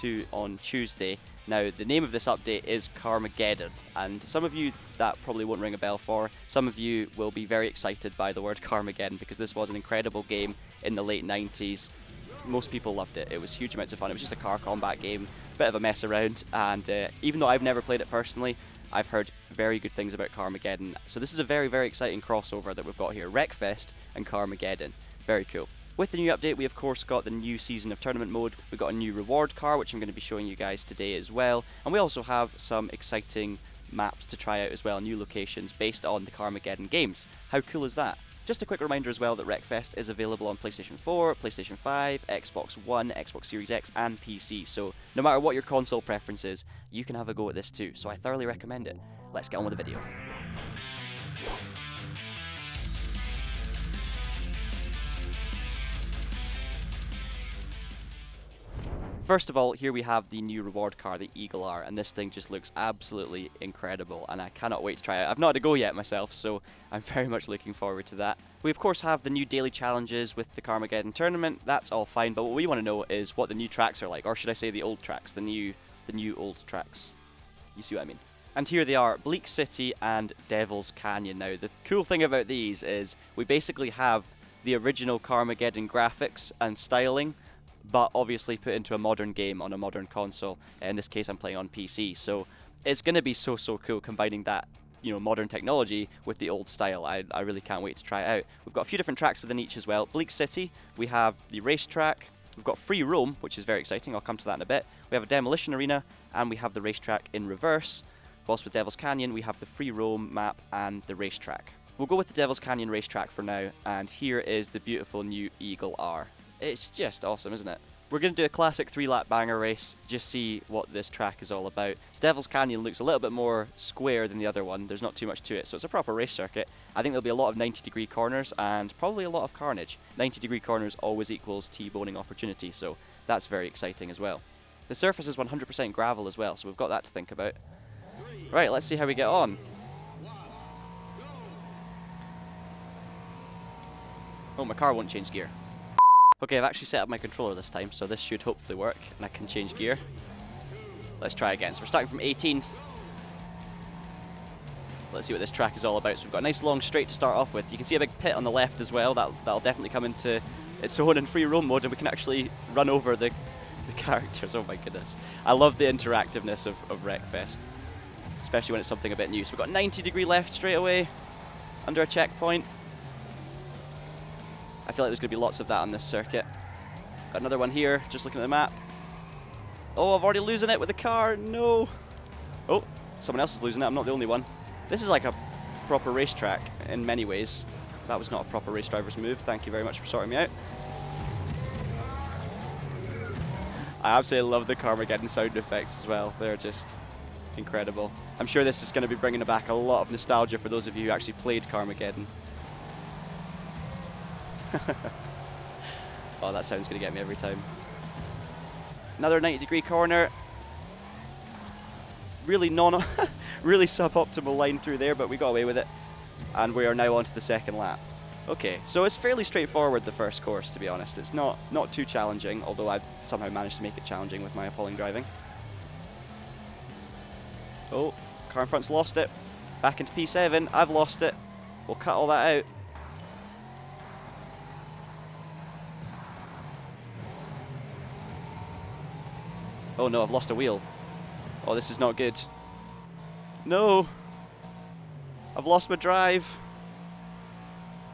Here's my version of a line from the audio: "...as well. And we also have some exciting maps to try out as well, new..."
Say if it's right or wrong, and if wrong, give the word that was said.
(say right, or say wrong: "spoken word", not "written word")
right.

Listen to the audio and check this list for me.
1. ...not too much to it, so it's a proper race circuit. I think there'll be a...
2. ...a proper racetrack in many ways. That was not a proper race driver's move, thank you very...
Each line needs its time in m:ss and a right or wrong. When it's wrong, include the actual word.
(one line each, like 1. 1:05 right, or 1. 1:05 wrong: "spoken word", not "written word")
1. 2:05 right
2. 3:05 right.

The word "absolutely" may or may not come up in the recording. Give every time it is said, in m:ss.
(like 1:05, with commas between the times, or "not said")
1:02, 3:14.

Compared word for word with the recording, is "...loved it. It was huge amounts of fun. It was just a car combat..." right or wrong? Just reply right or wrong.
right.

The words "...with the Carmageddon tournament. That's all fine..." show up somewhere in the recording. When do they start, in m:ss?
1:10.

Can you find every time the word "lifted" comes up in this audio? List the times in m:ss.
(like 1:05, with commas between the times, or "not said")
not said.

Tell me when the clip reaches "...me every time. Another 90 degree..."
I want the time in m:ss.
3:27.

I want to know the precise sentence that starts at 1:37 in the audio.
I, I really can't wait to try it out.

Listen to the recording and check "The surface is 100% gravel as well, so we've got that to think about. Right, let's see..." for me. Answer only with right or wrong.
right.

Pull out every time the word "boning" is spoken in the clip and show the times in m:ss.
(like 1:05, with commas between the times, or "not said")
2:11.